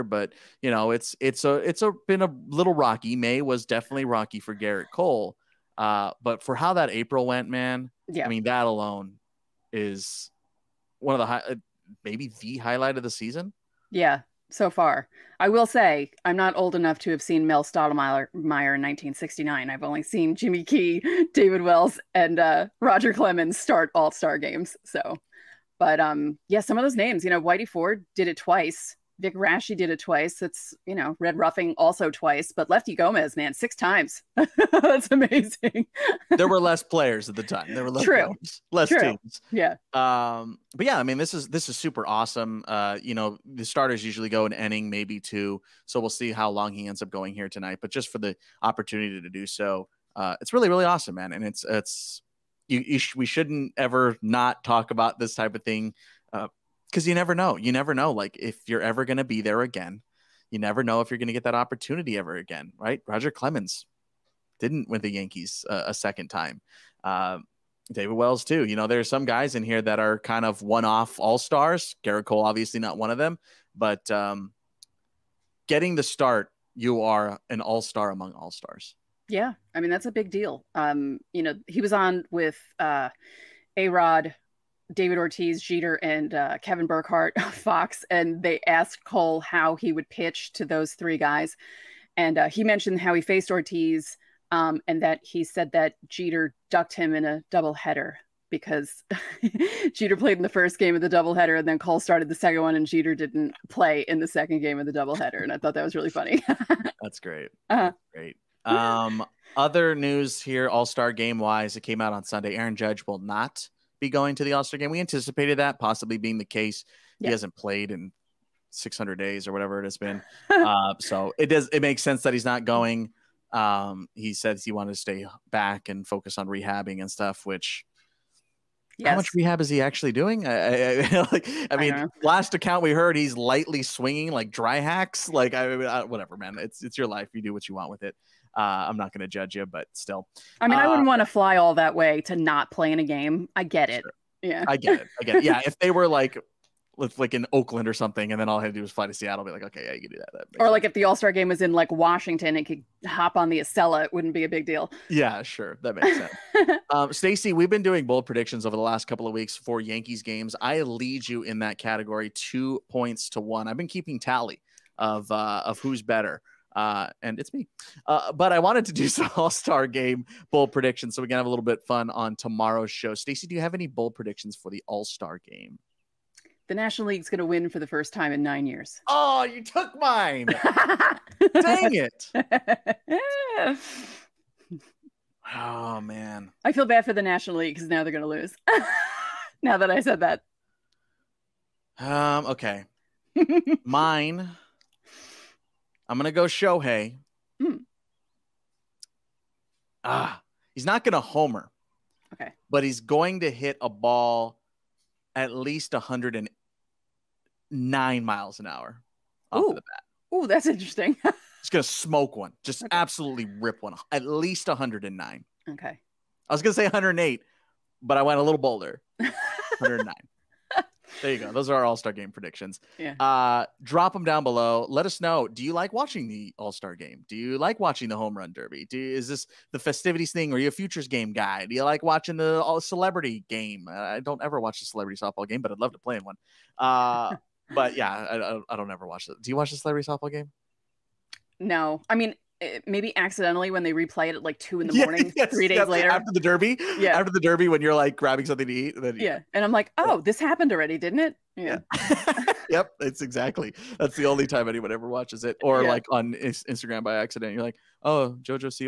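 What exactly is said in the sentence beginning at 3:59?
Do you watch the celebrity softball game?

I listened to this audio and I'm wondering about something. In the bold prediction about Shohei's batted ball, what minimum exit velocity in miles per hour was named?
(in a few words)
109.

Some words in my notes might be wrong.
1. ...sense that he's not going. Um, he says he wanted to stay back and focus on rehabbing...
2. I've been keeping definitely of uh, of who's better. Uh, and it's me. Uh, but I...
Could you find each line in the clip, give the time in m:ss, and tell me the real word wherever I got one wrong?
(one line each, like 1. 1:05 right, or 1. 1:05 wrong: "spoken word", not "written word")
1. 2:02 right
2. 2:43 wrong: "tally", not "definitely".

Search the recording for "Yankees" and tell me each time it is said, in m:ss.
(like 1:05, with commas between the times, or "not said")
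1:05, 2:39.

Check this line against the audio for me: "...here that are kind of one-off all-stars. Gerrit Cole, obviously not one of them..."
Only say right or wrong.
right.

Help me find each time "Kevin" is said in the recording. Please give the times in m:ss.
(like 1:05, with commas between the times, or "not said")
1:26.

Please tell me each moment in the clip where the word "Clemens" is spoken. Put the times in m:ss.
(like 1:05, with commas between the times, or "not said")
0:23, 1:03.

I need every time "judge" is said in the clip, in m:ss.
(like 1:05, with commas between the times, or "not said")
1:52, 2:19.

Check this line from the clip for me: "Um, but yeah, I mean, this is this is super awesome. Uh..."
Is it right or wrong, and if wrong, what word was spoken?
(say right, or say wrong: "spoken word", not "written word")
right.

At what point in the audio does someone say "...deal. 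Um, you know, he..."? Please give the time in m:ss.
1:20.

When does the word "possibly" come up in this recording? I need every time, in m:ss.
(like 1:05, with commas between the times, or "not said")
1:55.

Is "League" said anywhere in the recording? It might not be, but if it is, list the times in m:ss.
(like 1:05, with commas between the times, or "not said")
2:57, 3:07.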